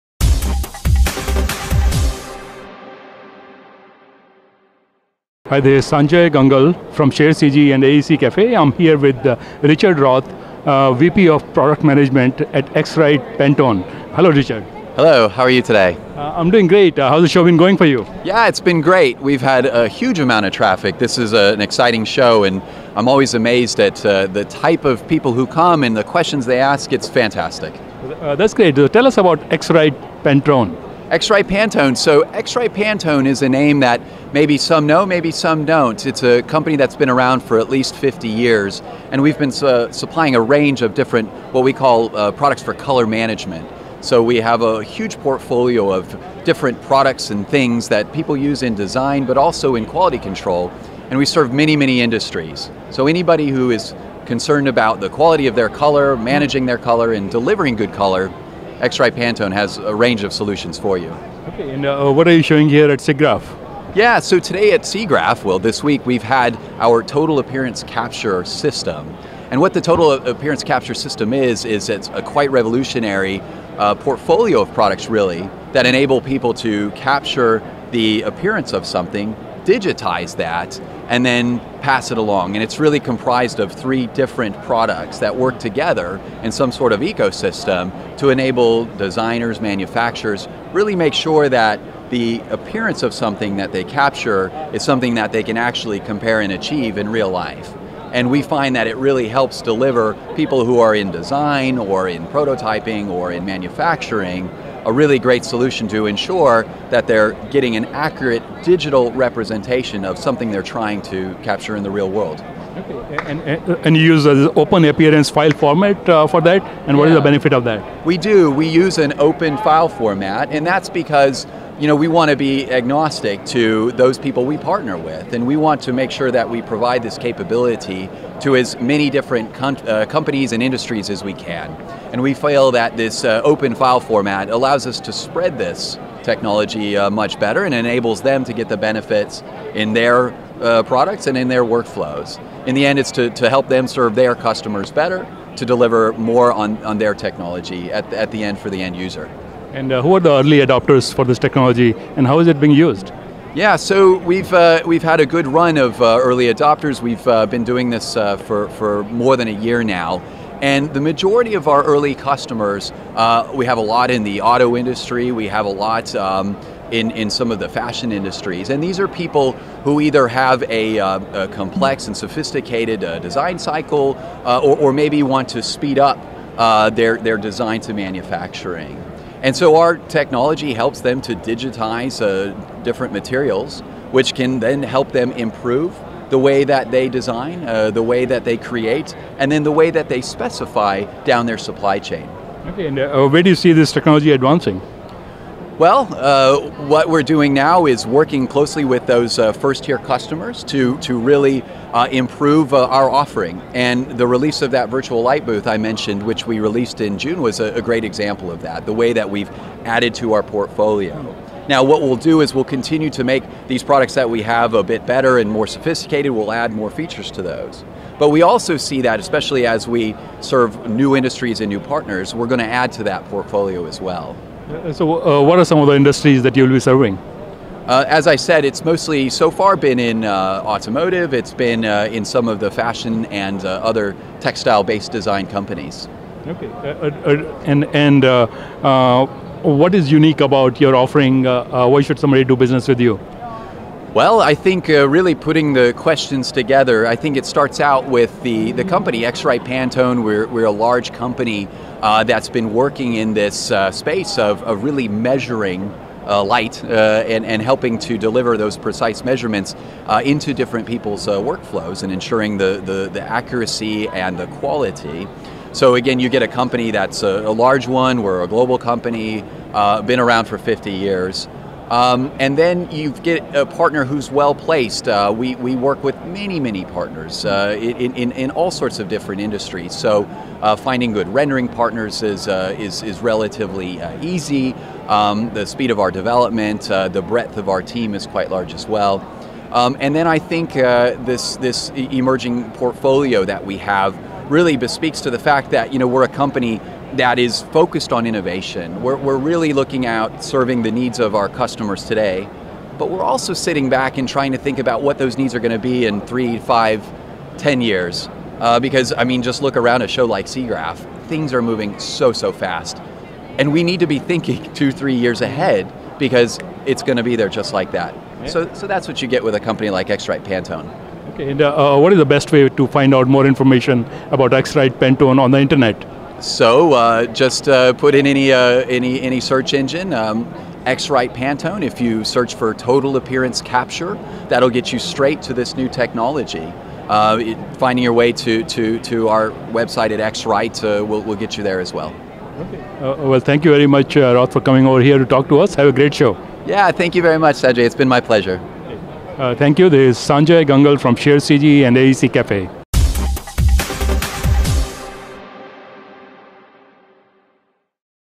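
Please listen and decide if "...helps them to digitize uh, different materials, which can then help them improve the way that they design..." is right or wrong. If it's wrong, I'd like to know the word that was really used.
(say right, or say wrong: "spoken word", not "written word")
right.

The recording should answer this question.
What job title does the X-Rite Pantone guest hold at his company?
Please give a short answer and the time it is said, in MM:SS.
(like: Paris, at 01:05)
VP of Product Management, at 00:10.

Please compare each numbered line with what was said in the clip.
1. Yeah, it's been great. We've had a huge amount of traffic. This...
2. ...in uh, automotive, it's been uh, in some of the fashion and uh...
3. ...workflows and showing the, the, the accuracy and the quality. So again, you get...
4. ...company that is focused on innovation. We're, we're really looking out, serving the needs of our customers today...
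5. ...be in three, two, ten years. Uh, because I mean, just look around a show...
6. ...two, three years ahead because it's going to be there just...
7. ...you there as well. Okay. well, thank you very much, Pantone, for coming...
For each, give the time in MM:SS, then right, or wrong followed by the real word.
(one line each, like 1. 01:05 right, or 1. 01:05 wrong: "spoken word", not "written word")
1. 00:18 right
2. 03:49 right
3. 04:21 wrong: "ensuring", not "showing"
4. 04:56 right
5. 05:05 wrong: "five", not "two"
6. 05:14 right
7. 05:41 wrong: "Roth", not "Pantone".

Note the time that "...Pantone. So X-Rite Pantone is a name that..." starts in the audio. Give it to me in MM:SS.
00:31.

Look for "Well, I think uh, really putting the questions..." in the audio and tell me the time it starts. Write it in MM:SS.
04:04.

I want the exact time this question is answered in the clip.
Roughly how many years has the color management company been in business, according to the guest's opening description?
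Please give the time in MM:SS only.
00:37.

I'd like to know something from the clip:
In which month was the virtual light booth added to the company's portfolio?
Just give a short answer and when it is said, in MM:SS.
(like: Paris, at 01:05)
June, at 03:27.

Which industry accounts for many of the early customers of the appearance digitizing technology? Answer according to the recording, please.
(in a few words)
Auto industry.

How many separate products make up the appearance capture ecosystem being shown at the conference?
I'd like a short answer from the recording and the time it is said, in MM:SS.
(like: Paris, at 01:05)
3, at 01:23.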